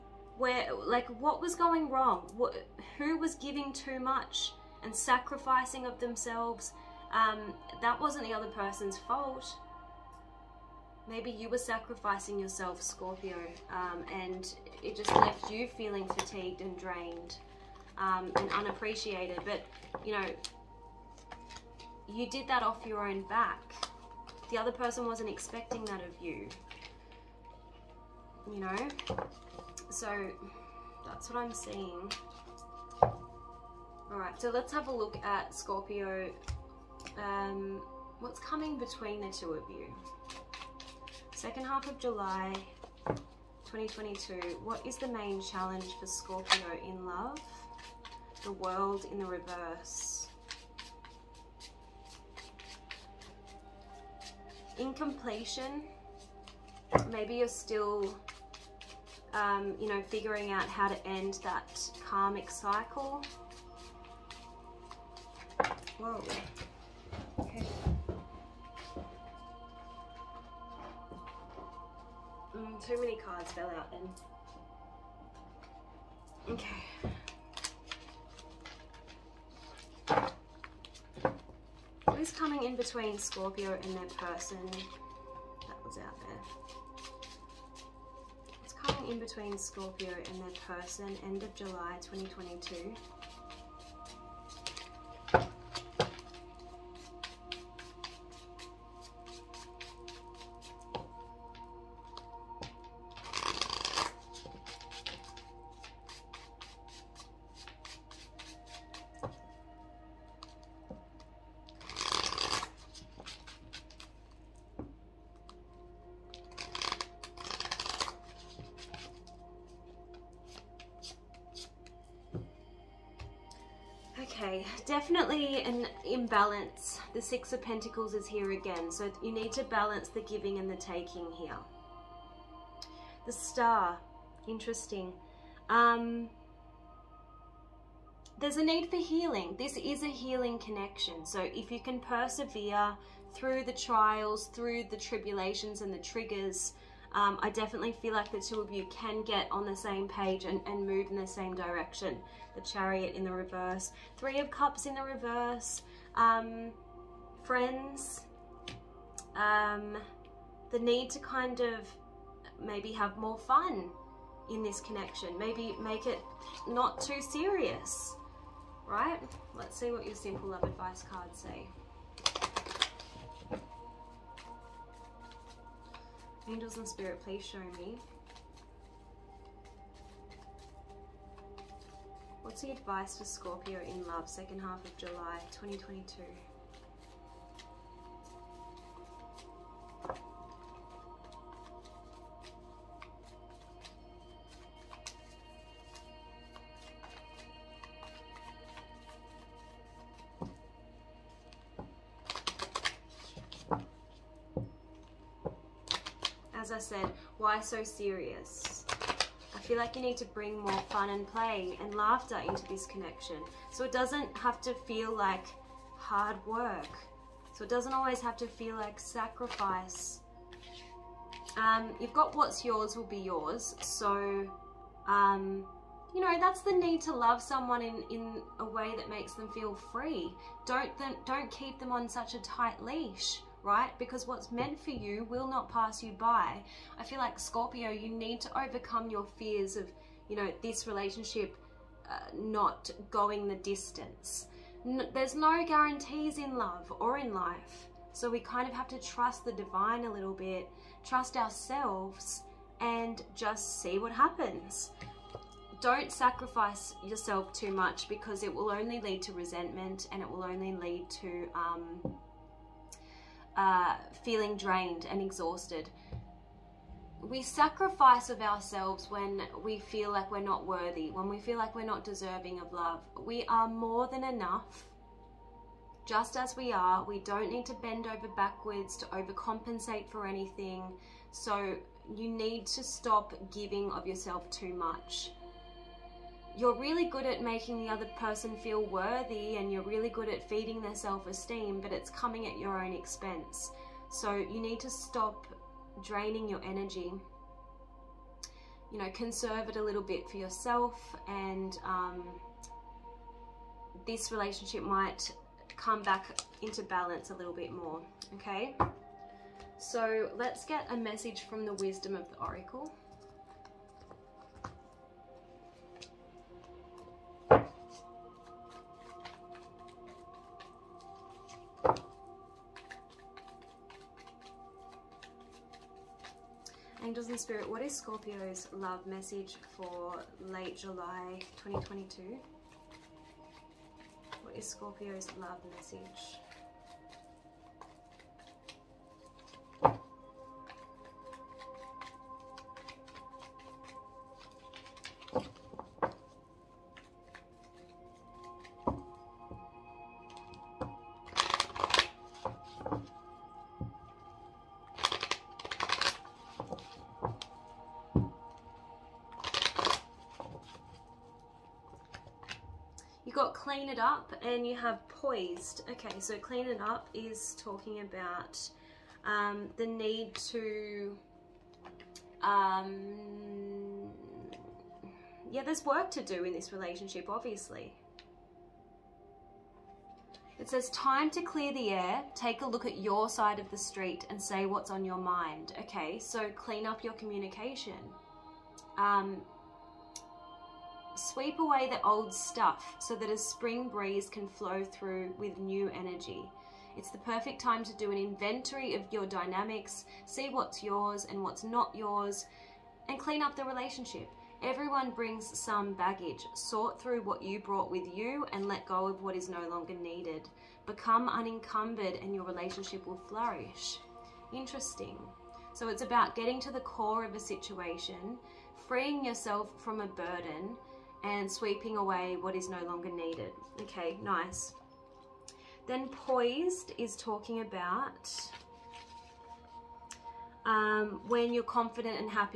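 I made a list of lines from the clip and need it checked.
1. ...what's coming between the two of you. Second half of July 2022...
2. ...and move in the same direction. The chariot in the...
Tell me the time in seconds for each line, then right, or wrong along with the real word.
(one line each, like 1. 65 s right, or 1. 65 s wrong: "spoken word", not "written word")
1. 38 s right
2. 150 s right.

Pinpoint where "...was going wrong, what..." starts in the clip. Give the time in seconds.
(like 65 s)
1 s.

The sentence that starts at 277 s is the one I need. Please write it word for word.
We don't need to bend over backwards to overcompensate for anything.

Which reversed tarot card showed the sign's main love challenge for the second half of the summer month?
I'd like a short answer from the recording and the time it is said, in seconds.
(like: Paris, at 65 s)
The World, at 48 s.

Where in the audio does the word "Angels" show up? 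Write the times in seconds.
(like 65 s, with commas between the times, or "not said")
176 s, 327 s.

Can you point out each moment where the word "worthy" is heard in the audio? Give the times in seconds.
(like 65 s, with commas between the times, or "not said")
270 s, 288 s.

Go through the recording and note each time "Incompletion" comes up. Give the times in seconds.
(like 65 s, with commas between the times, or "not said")
54 s.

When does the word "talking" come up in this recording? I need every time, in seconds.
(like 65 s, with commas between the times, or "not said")
367 s, 427 s.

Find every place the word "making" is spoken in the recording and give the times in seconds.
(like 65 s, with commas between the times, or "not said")
287 s.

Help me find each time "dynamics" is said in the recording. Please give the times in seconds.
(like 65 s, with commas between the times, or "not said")
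399 s.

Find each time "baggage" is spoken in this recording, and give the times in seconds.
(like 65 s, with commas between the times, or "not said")
405 s.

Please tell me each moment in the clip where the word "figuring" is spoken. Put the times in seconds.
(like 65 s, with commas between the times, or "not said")
60 s.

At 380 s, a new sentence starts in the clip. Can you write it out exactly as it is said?
It says, time to clear the air, take a look at your side of the street and say what's on your mind.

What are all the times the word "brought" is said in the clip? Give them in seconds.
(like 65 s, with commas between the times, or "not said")
407 s.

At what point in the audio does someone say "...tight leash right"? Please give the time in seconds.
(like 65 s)
232 s.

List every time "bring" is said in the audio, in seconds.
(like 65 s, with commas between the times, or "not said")
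210 s, 405 s.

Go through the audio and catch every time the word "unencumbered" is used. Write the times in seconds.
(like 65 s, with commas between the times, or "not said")
411 s.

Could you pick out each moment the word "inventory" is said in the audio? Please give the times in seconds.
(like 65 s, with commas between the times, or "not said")
398 s.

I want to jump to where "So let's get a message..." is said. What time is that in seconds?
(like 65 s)
309 s.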